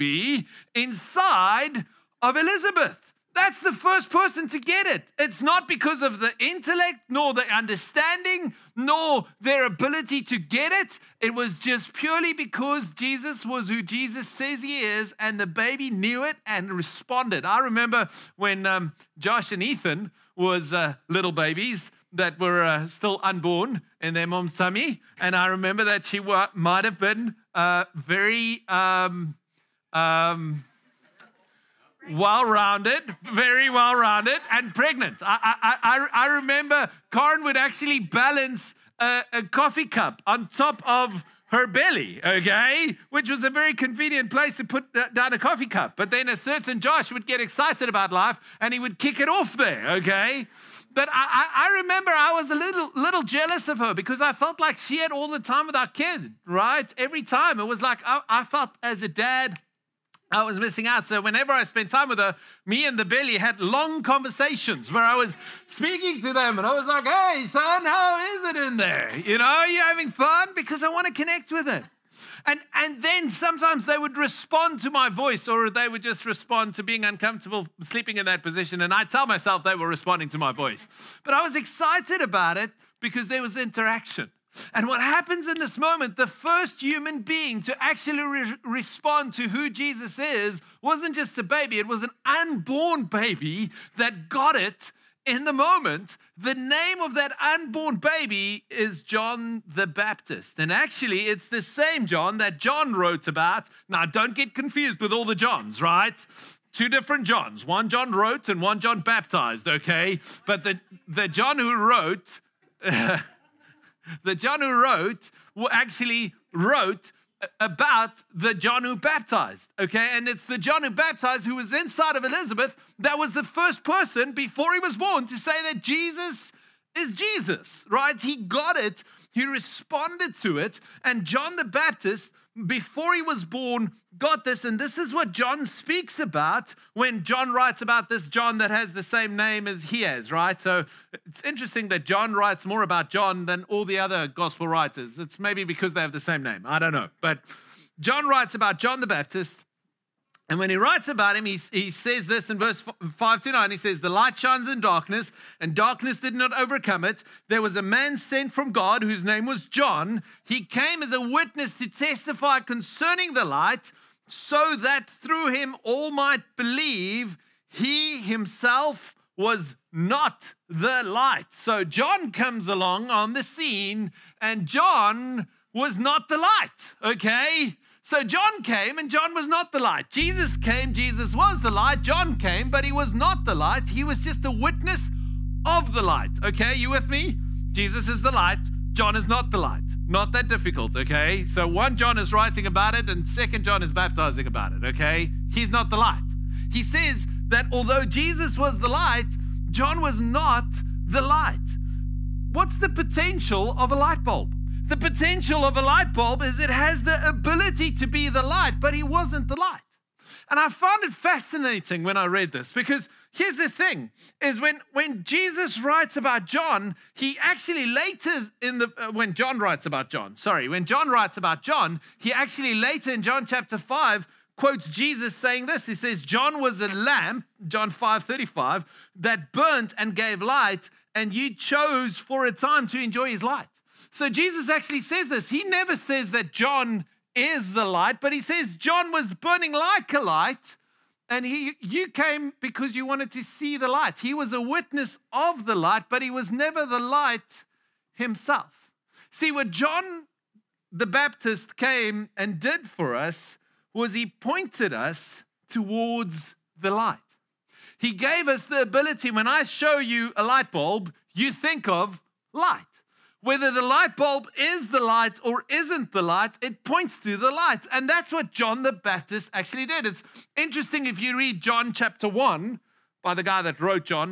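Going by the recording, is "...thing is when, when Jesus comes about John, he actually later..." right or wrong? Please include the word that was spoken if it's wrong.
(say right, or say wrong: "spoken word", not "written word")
wrong: "writes", not "comes".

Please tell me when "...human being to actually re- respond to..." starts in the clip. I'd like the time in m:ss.
1:26.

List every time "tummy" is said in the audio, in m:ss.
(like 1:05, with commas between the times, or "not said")
0:24.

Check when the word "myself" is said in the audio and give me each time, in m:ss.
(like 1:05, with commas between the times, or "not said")
1:19.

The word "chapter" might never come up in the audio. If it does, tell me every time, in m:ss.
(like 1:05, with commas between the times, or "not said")
3:43, 4:31.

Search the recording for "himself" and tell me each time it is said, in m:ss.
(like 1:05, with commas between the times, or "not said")
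2:48, 4:08.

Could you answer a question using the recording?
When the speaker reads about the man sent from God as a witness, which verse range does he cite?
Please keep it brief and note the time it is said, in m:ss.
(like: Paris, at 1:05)
verse 5 to 9, at 2:32.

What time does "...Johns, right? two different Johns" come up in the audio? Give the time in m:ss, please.
1:45.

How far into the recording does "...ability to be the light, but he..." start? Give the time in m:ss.
3:27.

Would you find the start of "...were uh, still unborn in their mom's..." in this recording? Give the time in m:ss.
0:22.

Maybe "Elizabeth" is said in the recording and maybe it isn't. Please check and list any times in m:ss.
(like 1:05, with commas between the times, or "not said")
0:02, 2:02.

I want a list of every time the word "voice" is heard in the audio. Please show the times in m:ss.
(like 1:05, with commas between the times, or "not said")
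1:15, 1:20.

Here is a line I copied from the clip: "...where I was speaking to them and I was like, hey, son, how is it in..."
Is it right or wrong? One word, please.
right.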